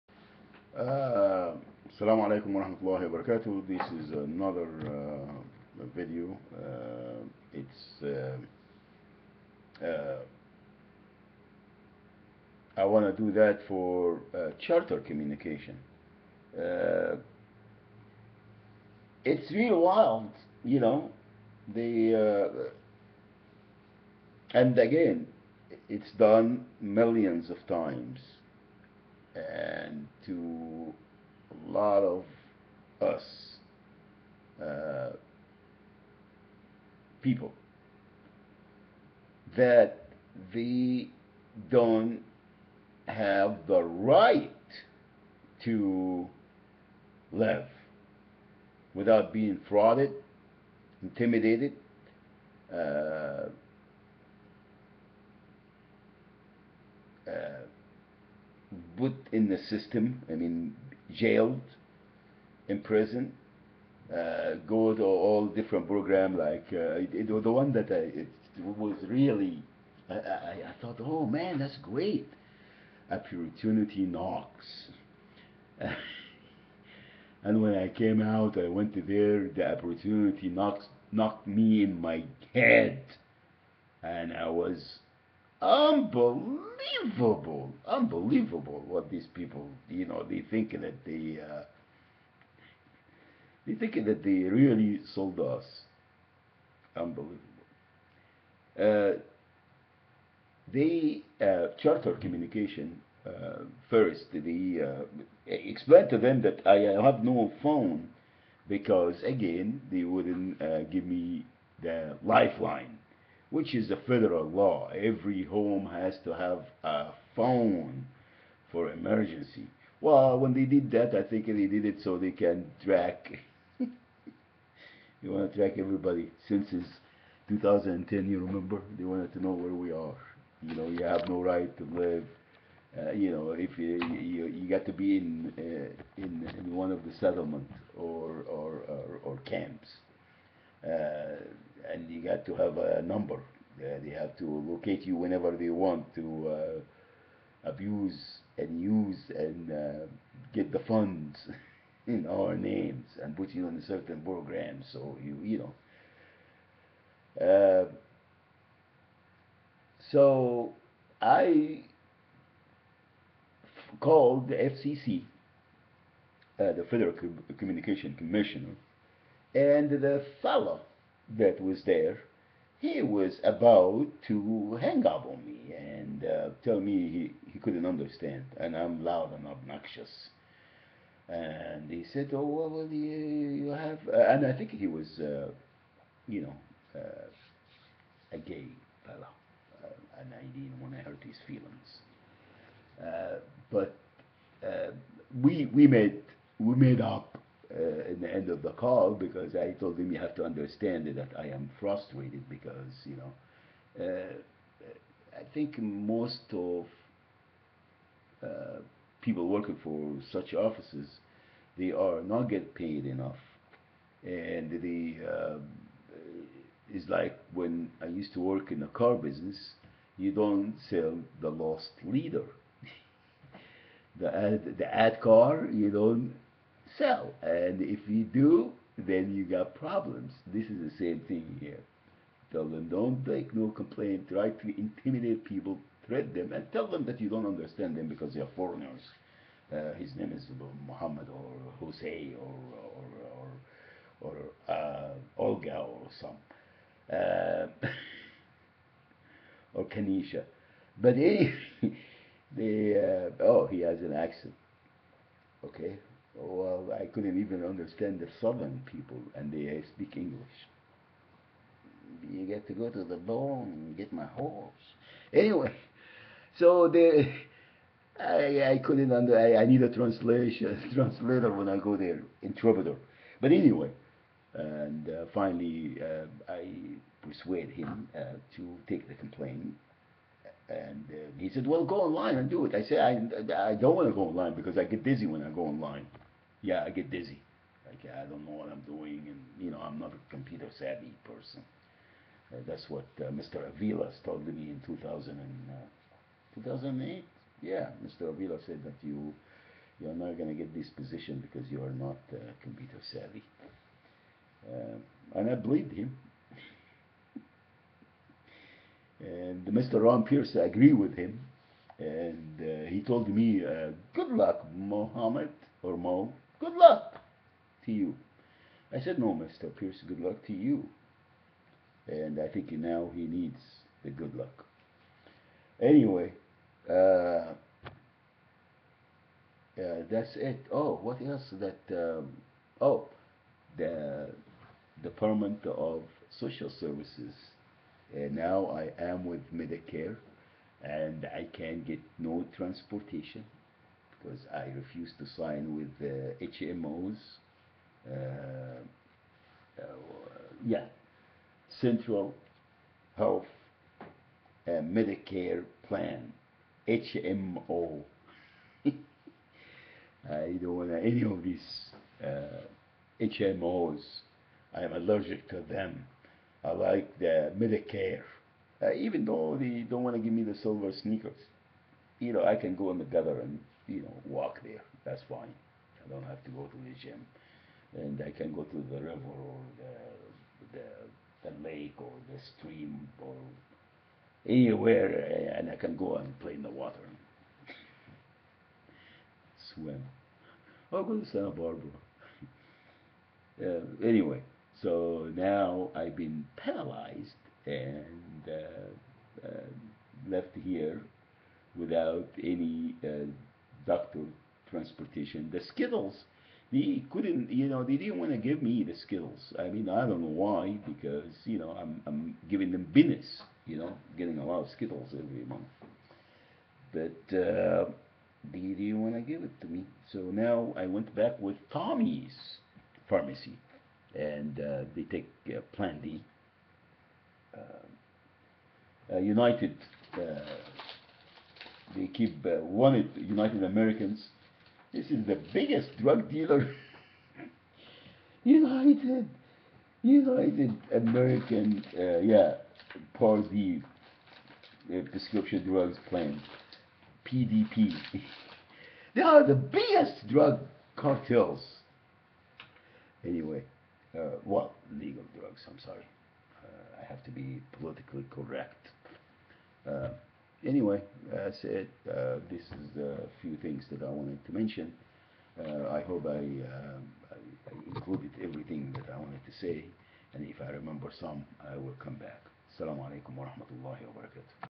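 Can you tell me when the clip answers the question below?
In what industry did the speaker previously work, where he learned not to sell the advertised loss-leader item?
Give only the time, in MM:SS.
03:38.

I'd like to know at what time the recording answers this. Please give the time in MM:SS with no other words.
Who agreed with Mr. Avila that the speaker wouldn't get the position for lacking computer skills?
05:10.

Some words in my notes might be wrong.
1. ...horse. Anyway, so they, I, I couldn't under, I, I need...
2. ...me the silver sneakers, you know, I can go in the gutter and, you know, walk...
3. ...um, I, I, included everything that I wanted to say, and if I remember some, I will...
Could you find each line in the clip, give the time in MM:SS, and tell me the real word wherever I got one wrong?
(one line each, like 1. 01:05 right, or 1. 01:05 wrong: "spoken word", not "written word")
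1. 04:24 right
2. 06:10 right
3. 07:46 right.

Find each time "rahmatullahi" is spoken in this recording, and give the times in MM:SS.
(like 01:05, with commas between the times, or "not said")
00:02, 07:53.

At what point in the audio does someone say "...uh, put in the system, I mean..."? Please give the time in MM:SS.
00:57.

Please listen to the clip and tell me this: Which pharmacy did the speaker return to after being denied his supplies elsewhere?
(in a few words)
Tommy's pharmacy.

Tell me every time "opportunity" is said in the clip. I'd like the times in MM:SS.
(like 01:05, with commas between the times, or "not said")
01:13, 01:19.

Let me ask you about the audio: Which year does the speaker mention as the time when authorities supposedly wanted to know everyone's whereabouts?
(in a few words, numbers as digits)
2010.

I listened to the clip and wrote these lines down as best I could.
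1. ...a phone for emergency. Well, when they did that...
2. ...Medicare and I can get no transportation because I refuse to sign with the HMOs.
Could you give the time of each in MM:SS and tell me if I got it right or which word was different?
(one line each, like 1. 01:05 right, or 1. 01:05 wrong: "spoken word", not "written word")
1. 01:56 right
2. 05:39 right.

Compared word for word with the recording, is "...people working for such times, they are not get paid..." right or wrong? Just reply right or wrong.
wrong.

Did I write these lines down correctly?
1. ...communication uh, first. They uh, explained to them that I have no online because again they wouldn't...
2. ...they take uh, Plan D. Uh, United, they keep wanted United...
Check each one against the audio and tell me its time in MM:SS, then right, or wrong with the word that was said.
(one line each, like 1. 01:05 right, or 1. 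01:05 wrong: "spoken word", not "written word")
1. 01:42 wrong: "phone", not "online"
2. 07:04 right.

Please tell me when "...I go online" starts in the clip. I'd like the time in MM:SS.
04:45.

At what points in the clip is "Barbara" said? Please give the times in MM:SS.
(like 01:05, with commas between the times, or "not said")
06:31.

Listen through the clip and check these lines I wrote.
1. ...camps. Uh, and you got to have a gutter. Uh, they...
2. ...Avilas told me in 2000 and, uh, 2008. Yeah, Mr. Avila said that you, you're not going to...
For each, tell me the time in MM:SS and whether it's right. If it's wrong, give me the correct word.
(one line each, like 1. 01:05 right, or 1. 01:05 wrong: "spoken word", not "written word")
1. 02:19 wrong: "number", not "gutter"
2. 04:53 right.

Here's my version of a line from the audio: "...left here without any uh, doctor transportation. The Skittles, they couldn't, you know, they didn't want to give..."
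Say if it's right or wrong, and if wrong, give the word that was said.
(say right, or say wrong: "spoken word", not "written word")
right.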